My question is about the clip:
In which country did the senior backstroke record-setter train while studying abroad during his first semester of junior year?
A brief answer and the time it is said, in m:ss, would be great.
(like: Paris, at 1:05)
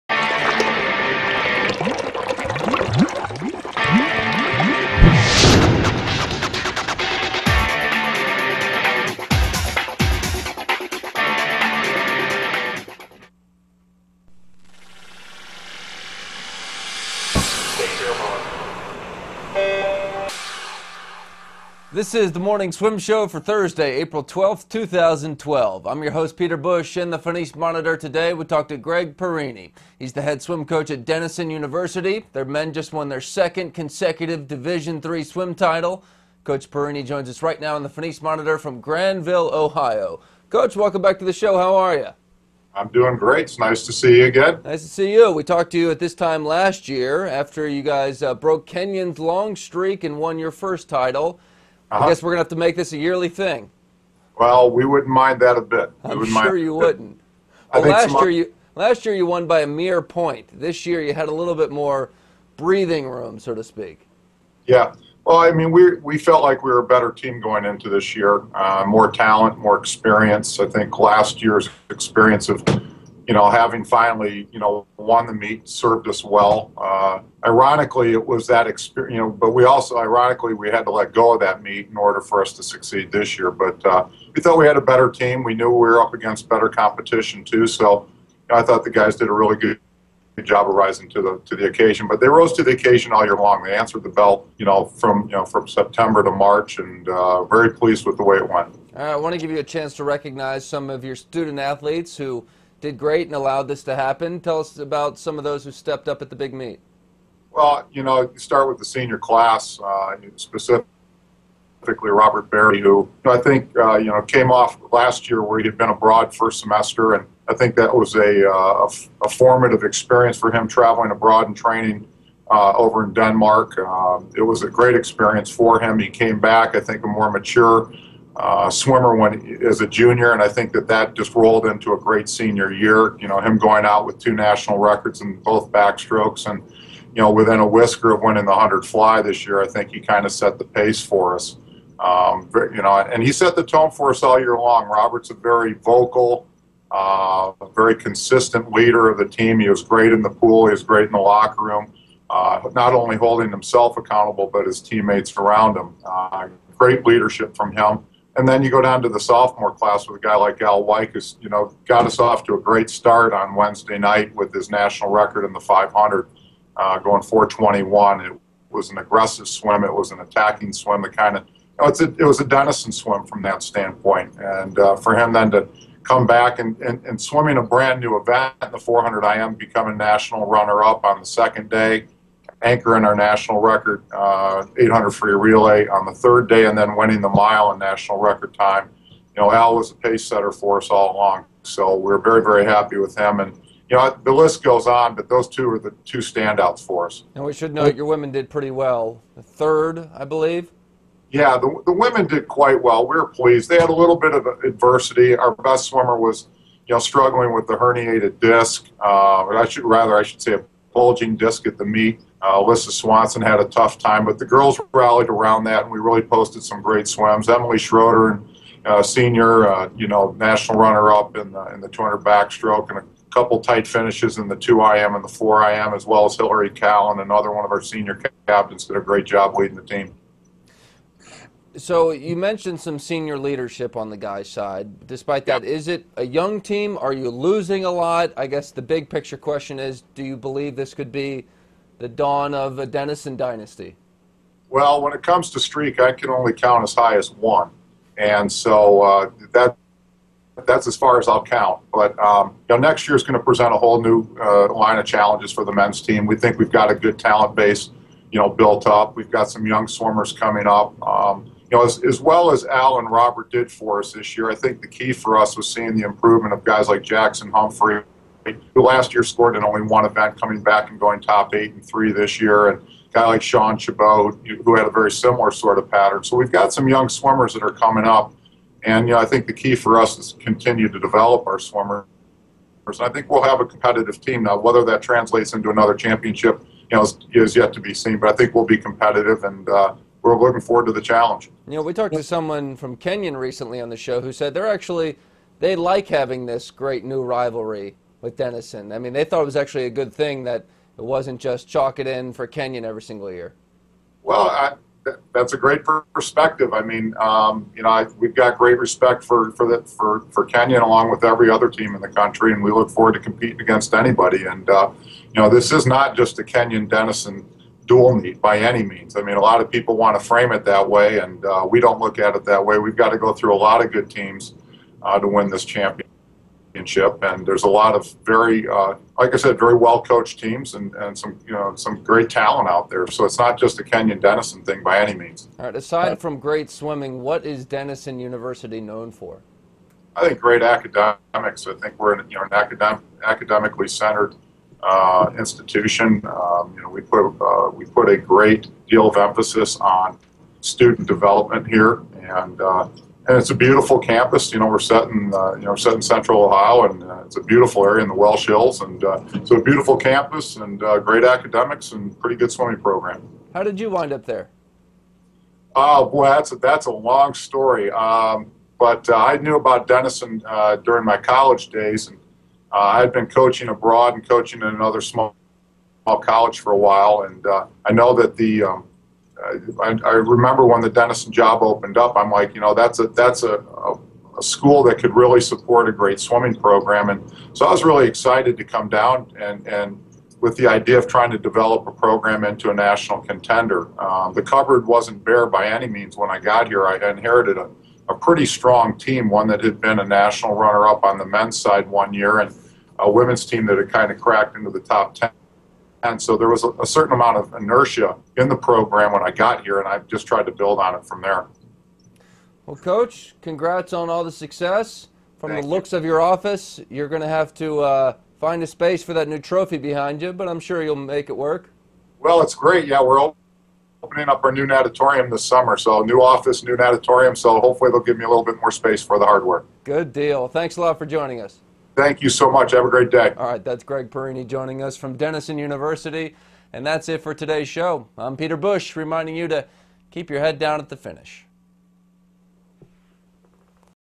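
Denmark, at 2:03.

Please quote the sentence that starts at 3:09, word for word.
You know, Al was a pace setter for us all along.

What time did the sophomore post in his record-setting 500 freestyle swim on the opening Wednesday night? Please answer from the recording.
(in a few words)
4:21.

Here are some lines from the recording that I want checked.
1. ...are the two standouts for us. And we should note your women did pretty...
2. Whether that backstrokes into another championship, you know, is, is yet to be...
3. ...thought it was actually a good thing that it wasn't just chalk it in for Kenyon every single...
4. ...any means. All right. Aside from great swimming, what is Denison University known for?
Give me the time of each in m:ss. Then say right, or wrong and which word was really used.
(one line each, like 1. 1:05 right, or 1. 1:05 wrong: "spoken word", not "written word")
1. 3:15 right
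2. 4:44 wrong: "translates", not "backstrokes"
3. 4:59 right
4. 5:34 right.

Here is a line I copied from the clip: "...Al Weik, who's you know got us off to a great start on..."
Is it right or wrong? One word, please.
right.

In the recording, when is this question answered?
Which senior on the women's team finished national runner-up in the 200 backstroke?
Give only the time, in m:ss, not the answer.
3:37.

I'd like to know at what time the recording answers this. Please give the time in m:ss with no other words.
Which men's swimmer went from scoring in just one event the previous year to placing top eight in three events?
4:27.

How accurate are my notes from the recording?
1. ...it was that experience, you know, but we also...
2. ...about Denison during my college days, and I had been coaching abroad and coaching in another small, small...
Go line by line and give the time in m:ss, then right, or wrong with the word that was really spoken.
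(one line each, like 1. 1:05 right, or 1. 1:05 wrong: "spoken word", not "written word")
1. 1:18 right
2. 6:09 right.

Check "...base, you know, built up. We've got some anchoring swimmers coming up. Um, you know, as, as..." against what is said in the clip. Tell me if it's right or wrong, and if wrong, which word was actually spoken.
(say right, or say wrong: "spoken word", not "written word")
wrong: "young", not "anchoring".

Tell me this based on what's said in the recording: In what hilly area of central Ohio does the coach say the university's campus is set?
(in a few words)
Welsh Hills.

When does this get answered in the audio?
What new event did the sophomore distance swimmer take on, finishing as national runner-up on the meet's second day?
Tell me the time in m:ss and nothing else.
2:58.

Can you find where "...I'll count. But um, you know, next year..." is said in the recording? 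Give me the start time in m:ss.
4:11.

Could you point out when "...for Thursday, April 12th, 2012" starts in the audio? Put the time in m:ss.
0:23.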